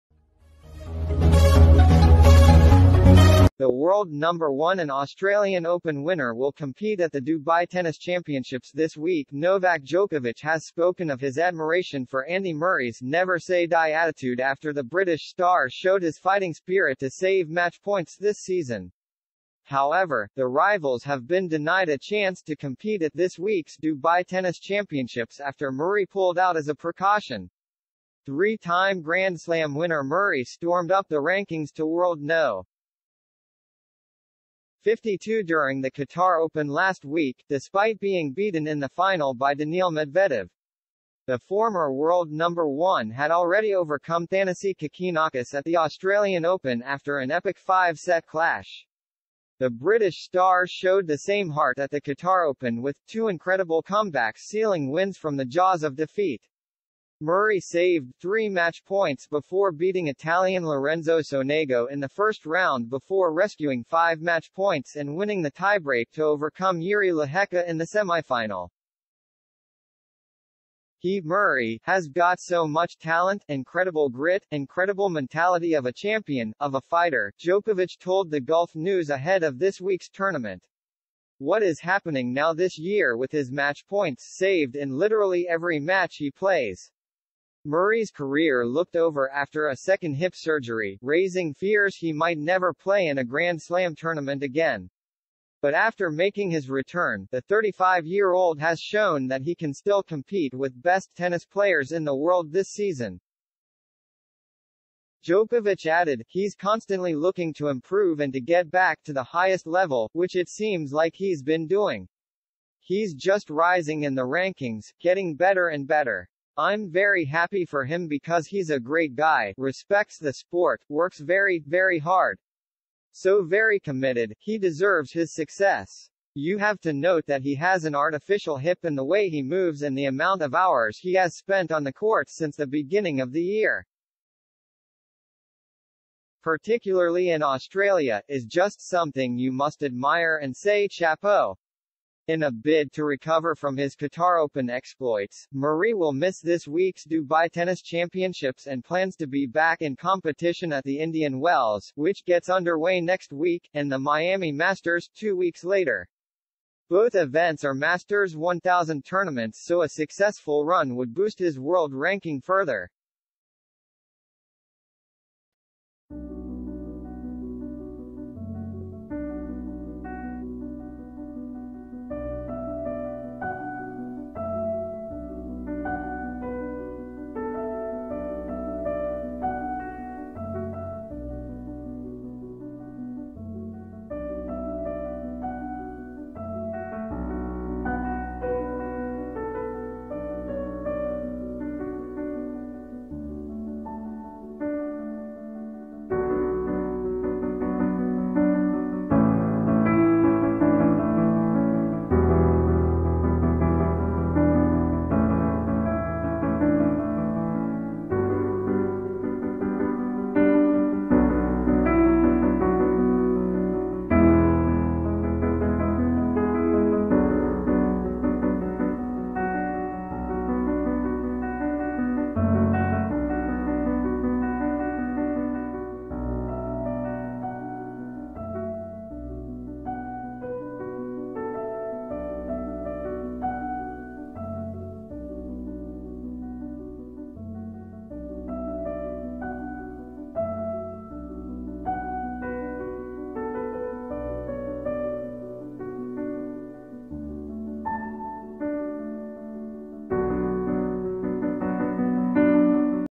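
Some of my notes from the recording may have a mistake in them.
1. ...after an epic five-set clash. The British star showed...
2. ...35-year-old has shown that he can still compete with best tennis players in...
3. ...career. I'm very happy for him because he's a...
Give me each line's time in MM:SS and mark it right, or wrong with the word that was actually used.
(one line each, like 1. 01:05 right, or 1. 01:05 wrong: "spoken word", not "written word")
1. 00:46 right
2. 01:37 right
3. 01:55 wrong: "better", not "career".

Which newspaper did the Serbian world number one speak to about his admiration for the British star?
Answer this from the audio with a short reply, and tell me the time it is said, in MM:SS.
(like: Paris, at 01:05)
Gulf News, at 01:18.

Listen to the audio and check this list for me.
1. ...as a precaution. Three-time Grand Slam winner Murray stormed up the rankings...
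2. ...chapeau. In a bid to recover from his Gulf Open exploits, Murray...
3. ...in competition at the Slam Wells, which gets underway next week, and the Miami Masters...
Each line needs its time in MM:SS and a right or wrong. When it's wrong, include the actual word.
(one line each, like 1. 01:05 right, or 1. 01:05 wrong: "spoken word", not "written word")
1. 00:26 right
2. 02:20 wrong: "Qatar", not "Gulf"
3. 02:29 wrong: "Indian", not "Slam".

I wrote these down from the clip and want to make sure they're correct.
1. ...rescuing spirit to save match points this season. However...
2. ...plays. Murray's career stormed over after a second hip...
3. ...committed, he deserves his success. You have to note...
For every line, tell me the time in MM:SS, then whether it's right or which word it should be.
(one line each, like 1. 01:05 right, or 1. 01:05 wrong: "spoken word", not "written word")
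1. 00:16 wrong: "fighting", not "rescuing"
2. 01:26 wrong: "looked", not "stormed"
3. 02:03 right.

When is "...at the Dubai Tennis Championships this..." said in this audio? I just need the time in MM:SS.
00:06.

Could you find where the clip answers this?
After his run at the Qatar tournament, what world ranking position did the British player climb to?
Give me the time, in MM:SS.
00:34.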